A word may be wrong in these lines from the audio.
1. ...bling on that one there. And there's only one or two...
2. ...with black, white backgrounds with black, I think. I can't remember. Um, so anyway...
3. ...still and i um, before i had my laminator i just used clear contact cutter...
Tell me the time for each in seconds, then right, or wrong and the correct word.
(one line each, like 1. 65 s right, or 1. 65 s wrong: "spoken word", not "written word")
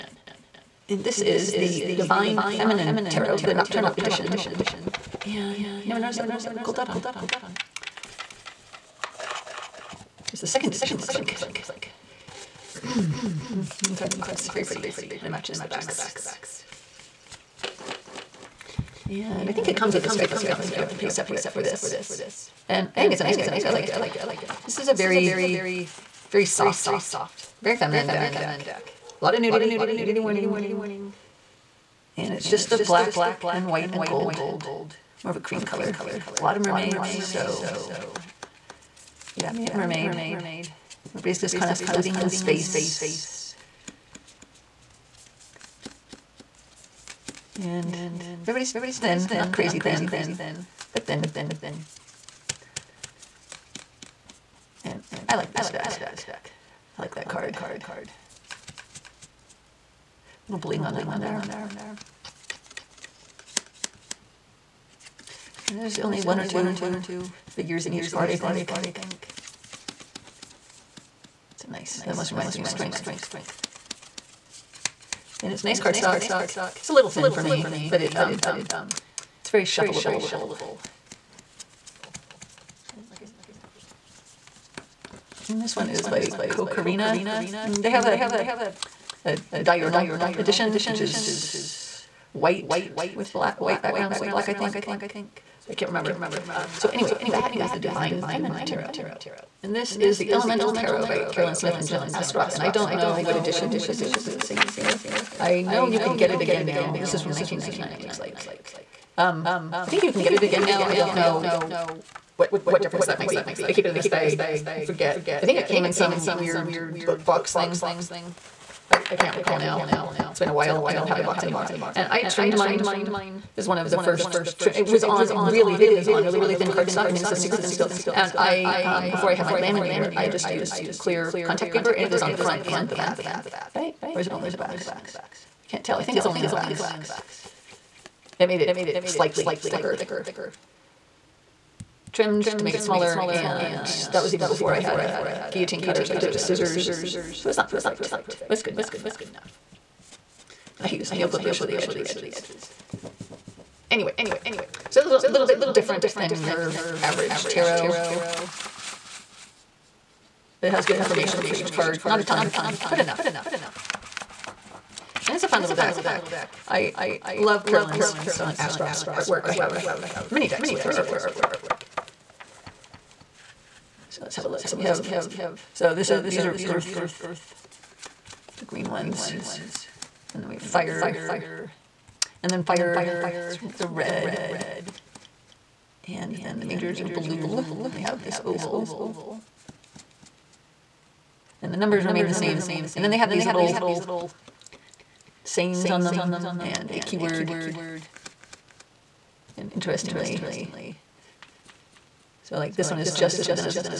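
1. 60 s right
2. 93 s right
3. 127 s wrong: "paper", not "cutter".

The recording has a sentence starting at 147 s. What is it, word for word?
So it's not perfect, but it's good enough.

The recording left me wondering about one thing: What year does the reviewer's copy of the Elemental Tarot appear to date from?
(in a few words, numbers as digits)
1999.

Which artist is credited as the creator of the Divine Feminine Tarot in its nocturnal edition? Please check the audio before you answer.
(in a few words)
Cocorrina.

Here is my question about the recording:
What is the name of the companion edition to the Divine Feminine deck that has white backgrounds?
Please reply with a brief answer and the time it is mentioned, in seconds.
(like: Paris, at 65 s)
diurnal edition, at 89 s.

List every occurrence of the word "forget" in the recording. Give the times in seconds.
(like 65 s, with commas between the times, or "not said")
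114 s.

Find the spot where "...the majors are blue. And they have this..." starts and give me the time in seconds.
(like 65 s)
186 s.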